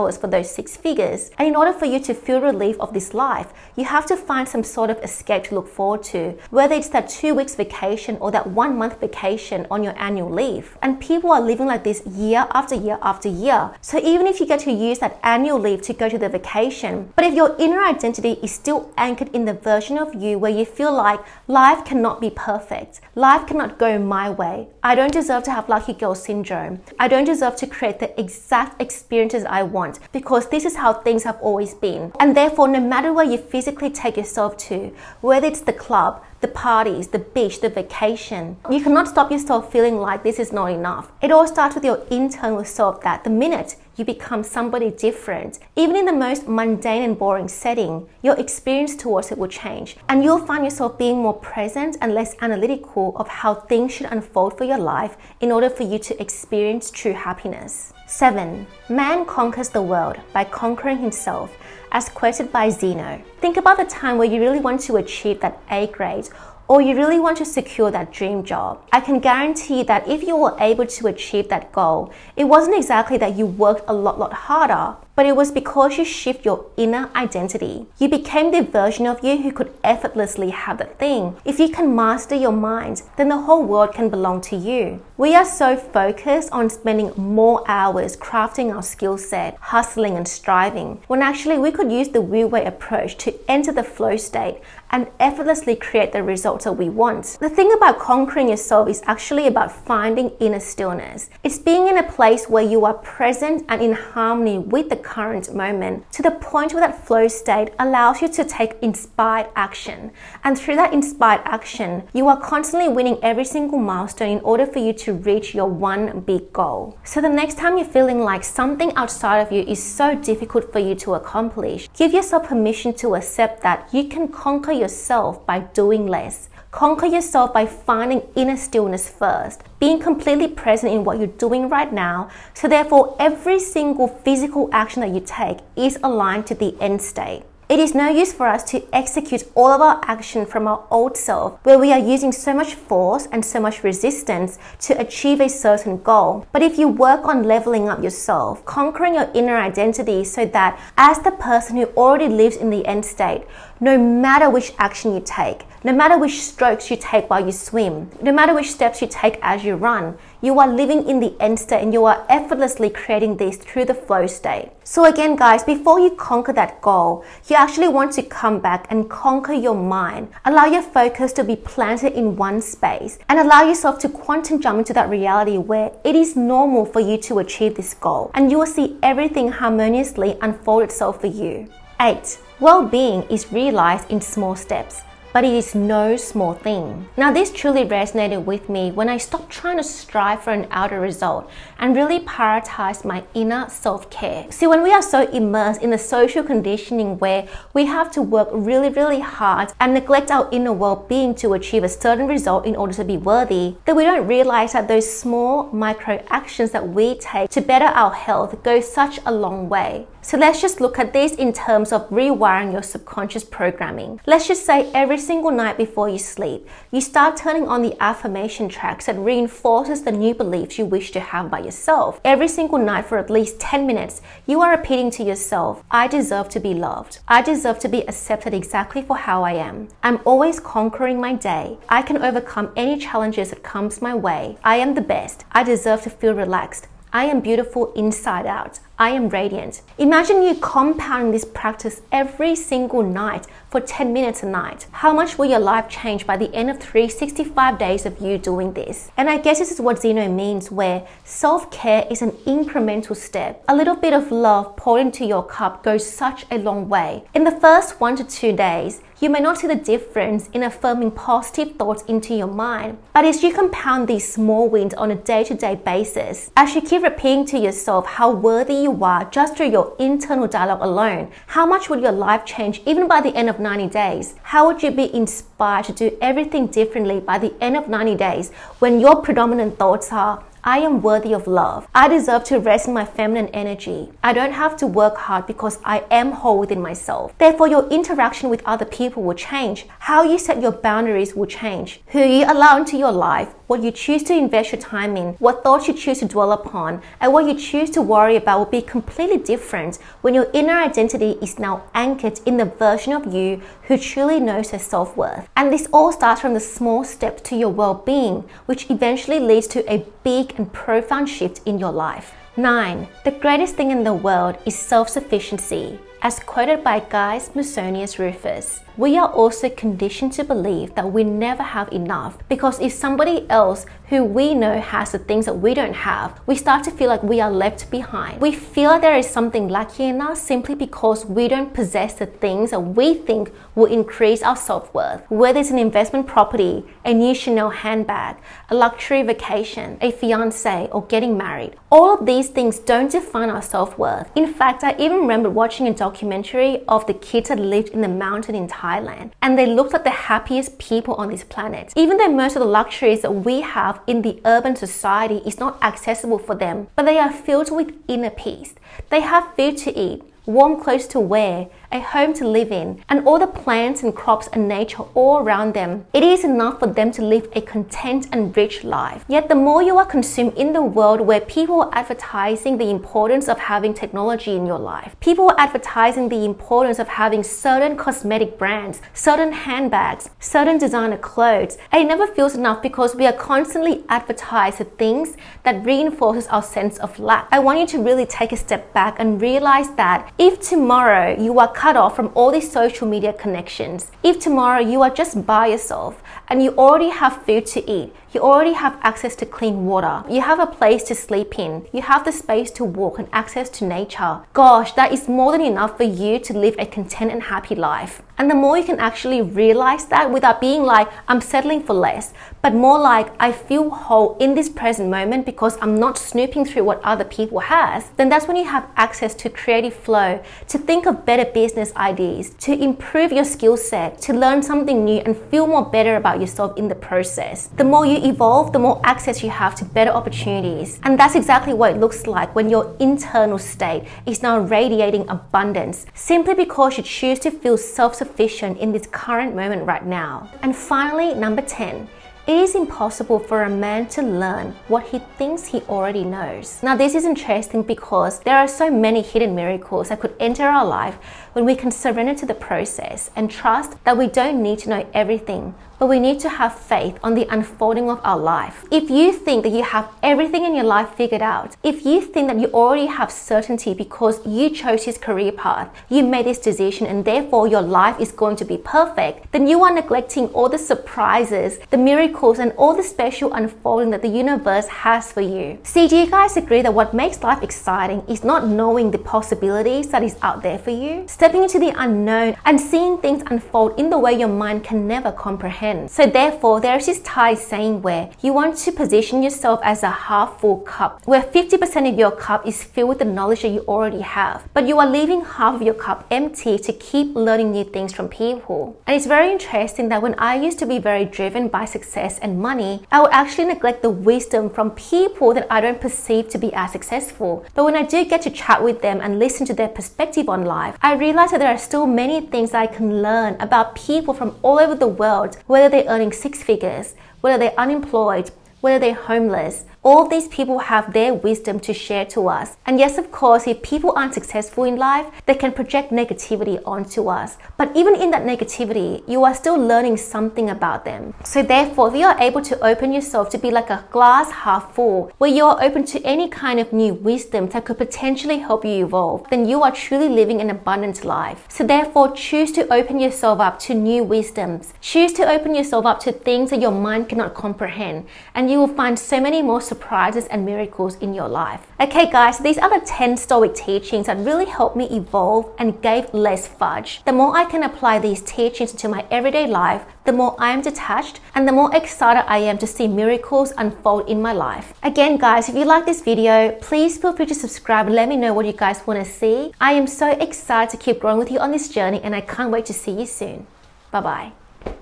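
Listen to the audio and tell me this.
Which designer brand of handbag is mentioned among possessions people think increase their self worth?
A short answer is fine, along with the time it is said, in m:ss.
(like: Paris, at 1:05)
Chanel, at 5:37.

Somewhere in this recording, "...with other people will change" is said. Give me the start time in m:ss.
4:48.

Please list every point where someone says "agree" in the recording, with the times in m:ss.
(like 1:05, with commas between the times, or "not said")
7:56.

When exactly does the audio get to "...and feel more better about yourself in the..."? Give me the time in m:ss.
7:05.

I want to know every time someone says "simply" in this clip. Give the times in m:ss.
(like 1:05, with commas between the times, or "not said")
5:30, 7:16.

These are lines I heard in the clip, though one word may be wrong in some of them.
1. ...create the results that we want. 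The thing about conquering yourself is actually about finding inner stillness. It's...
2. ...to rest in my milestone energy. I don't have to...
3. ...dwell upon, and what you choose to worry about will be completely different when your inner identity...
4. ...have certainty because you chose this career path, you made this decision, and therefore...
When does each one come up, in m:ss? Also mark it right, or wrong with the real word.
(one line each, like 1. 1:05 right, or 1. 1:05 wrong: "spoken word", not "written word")
1. 1:35 right
2. 4:42 wrong: "feminine", not "milestone"
3. 4:56 right
4. 7:43 right.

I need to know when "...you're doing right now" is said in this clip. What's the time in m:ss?
2:11.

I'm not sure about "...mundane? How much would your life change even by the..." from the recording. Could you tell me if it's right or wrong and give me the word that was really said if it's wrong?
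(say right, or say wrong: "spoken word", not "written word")
wrong: "alone", not "mundane".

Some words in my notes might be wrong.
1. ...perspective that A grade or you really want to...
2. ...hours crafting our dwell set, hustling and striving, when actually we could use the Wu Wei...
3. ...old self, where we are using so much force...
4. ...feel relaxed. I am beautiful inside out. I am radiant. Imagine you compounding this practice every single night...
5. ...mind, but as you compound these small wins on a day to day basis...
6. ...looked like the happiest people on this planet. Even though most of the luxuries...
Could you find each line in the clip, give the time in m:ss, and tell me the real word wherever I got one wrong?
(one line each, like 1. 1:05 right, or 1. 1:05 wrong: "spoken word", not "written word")
1. 1:04 wrong: "achieve", not "perspective"
2. 1:27 wrong: "skill", not "dwell"
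3. 2:20 right
4. 3:56 right
5. 4:22 right
6. 5:49 right.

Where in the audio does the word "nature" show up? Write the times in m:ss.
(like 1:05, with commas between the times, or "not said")
6:04, 6:43.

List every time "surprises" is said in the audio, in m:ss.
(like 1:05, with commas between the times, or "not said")
7:50, 9:09.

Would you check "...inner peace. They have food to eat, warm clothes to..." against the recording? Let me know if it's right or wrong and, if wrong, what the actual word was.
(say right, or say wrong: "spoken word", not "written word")
right.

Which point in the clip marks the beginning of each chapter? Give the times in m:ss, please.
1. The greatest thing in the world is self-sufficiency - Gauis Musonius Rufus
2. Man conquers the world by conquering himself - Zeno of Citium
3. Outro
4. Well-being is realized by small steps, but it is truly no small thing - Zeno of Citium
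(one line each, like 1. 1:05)
1. 5:13
2. 1:00
3. 9:14
4. 3:04.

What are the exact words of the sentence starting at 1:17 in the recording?
You became the version of you who could effortlessly have the thing.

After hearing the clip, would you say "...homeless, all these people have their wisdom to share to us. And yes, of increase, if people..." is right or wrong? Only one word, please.
wrong.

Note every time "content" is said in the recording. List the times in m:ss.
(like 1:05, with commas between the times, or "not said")
6:07, 6:46.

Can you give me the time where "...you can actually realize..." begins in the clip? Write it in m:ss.
6:48.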